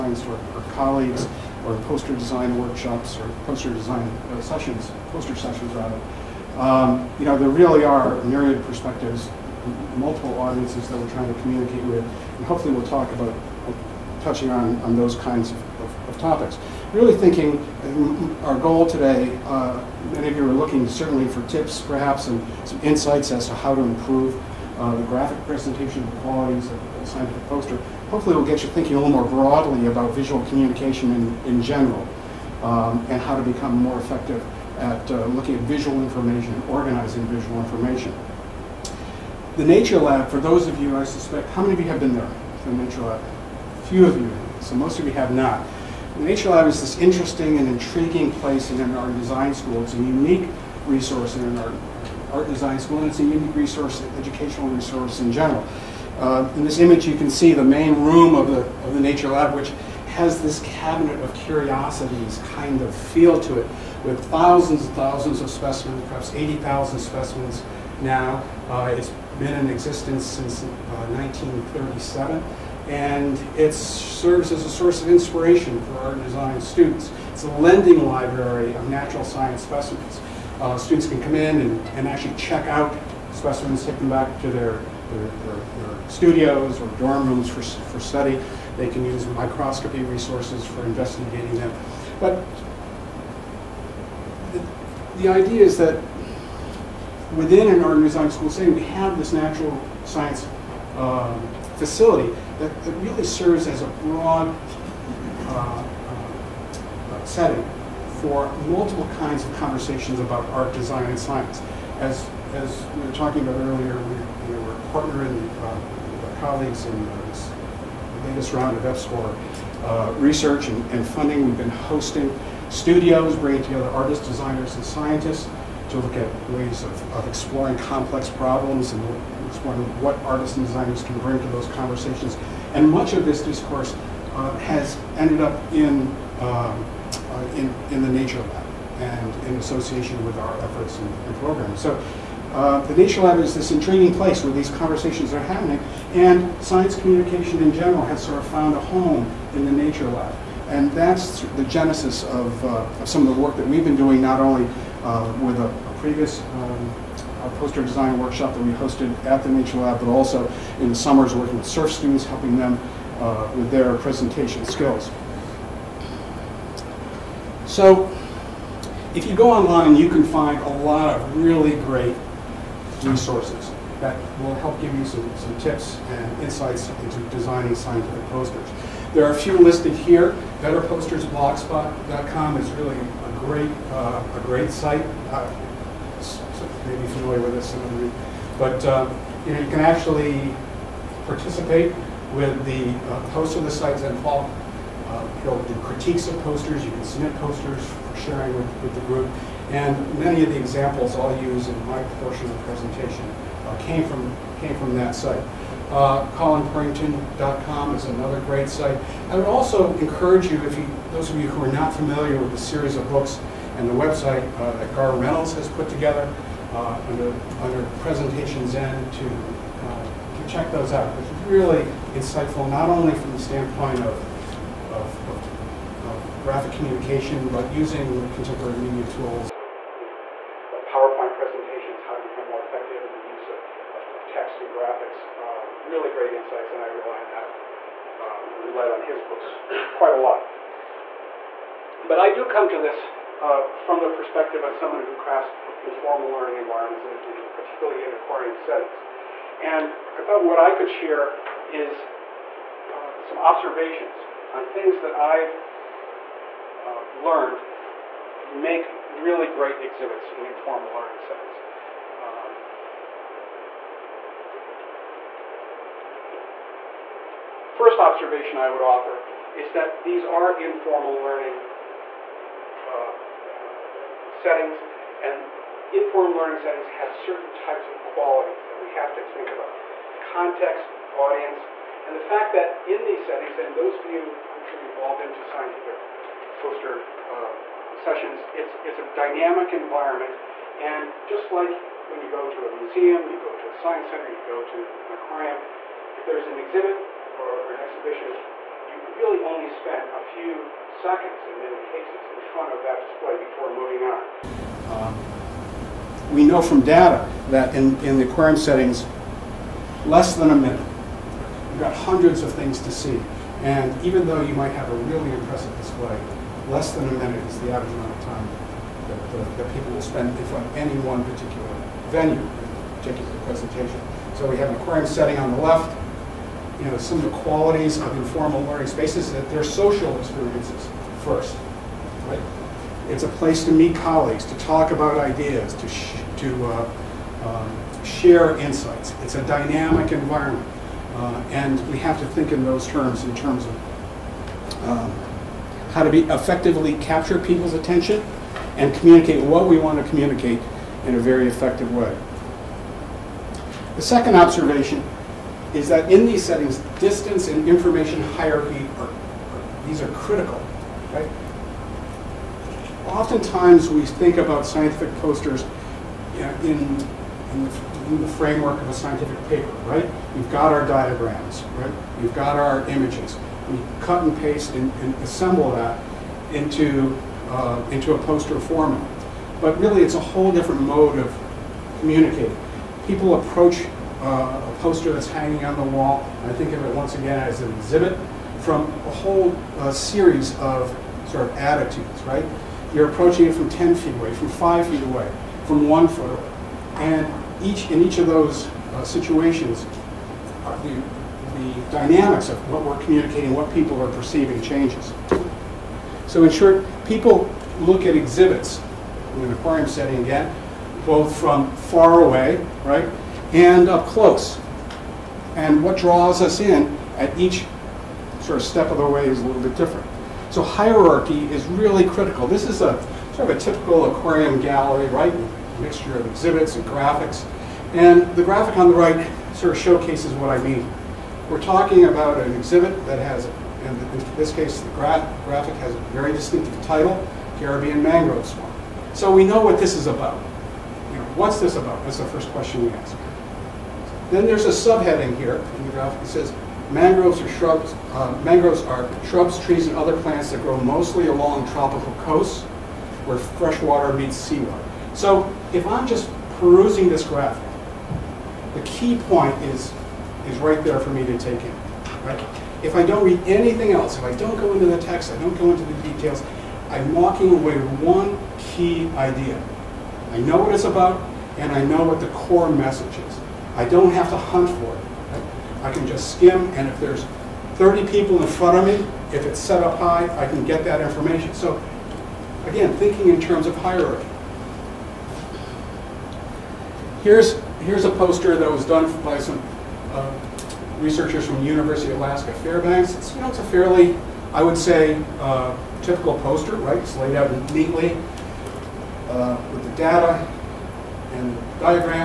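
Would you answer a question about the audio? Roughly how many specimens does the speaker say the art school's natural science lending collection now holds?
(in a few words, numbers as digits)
80,000.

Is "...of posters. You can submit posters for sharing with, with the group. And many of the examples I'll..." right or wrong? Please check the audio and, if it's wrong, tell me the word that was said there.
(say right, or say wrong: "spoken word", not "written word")
right.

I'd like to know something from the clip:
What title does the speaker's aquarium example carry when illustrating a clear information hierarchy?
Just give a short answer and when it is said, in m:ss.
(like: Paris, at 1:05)
Caribbean Mangrove Swamp, at 7:17.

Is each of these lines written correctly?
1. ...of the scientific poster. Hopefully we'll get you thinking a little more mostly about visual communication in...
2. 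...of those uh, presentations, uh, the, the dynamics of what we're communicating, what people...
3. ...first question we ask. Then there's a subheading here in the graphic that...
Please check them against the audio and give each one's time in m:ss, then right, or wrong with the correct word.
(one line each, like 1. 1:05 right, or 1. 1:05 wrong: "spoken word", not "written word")
1. 0:26 wrong: "broadly", not "mostly"
2. 6:38 wrong: "situations", not "presentations"
3. 7:22 right.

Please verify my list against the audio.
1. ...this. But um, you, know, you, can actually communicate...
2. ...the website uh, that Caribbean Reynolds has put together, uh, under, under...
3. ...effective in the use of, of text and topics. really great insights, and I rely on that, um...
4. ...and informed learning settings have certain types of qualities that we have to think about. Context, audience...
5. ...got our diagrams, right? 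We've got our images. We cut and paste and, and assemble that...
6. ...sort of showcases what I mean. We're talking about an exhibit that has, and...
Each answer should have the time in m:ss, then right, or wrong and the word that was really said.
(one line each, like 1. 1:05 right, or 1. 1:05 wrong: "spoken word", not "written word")
1. 3:07 wrong: "participate", not "communicate"
2. 3:33 wrong: "Garr", not "Caribbean"
3. 3:52 wrong: "graphics", not "topics"
4. 4:35 right
5. 6:10 right
6. 7:09 right.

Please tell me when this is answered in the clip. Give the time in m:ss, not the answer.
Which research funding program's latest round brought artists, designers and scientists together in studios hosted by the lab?
1:58.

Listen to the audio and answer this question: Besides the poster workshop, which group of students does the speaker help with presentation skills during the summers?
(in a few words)
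SURF students.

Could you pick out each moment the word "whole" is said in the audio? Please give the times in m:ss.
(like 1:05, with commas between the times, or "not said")
6:20, 6:29.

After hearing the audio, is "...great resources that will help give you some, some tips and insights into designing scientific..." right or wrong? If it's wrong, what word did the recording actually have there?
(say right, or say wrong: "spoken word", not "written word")
right.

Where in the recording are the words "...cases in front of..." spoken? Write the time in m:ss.
5:01.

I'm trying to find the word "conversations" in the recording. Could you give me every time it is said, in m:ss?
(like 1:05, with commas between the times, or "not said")
1:49, 2:11, 2:24.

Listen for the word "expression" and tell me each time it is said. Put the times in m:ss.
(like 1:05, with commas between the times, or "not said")
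not said.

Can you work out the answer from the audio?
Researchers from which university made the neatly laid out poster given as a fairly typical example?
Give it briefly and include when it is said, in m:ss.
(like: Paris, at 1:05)
University of Alaska Fairbanks, at 8:11.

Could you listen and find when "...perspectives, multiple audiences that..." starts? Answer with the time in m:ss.
0:08.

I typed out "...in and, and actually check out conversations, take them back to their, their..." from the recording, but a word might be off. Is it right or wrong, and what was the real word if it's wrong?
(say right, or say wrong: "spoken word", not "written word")
wrong: "specimens", not "conversations".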